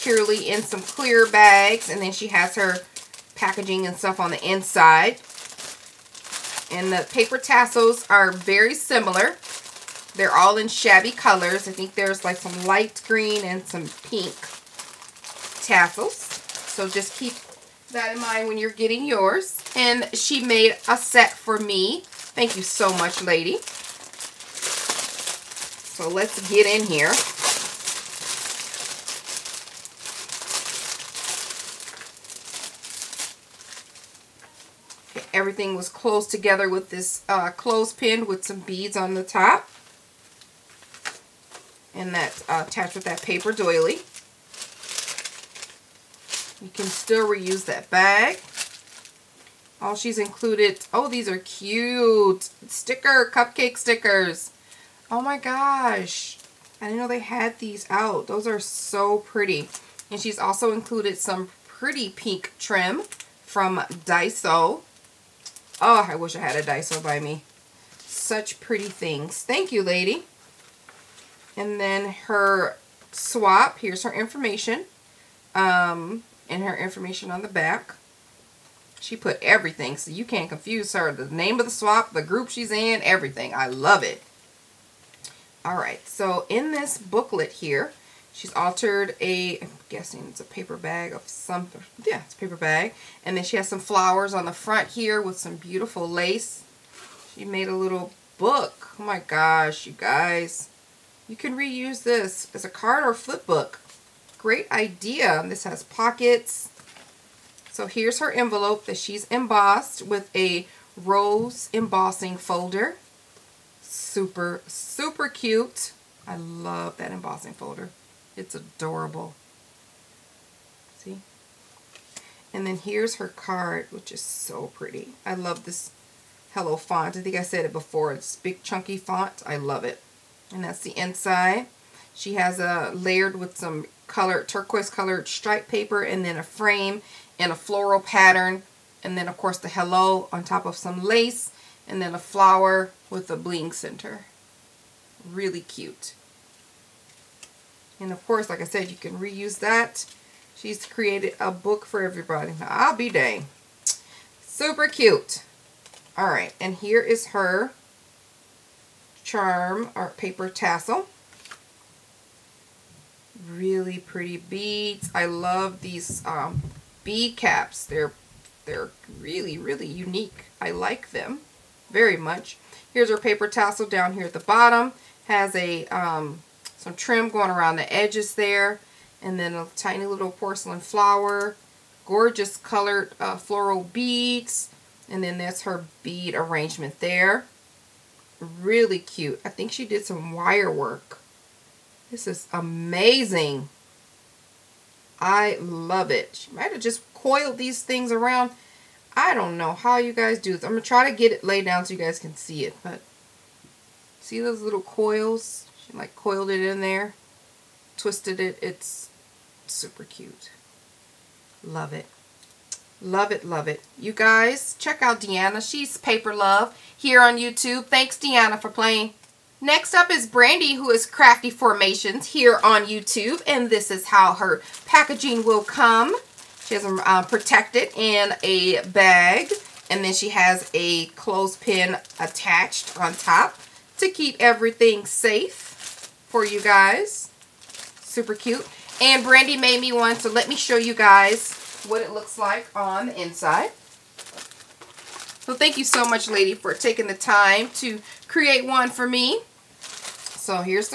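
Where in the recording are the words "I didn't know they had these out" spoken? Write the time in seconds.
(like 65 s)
56 s.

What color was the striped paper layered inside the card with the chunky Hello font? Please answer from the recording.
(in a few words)
Turquoise.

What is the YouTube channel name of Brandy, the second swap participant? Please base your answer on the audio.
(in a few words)
Crafty Formations.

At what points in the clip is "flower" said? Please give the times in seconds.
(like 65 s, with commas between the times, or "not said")
93 s, 142 s, 180 s.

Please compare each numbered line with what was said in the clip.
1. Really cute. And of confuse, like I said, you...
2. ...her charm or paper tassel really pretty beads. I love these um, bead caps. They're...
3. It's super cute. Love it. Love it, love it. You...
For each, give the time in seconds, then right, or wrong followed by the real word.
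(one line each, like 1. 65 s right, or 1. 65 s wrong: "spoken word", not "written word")
1. 145 s wrong: "course", not "confuse"
2. 157 s right
3. 208 s right.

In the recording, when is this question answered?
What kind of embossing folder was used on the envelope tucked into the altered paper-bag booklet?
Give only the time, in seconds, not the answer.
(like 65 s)
110 s.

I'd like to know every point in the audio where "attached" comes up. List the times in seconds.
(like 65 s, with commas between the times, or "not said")
42 s, 232 s.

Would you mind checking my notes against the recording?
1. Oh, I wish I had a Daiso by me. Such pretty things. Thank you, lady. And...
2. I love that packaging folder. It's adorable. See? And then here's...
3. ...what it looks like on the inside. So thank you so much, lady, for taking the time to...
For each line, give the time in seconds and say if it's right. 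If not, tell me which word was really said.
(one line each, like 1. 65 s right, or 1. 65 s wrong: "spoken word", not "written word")
1. 65 s right
2. 116 s wrong: "embossing", not "packaging"
3. 241 s right.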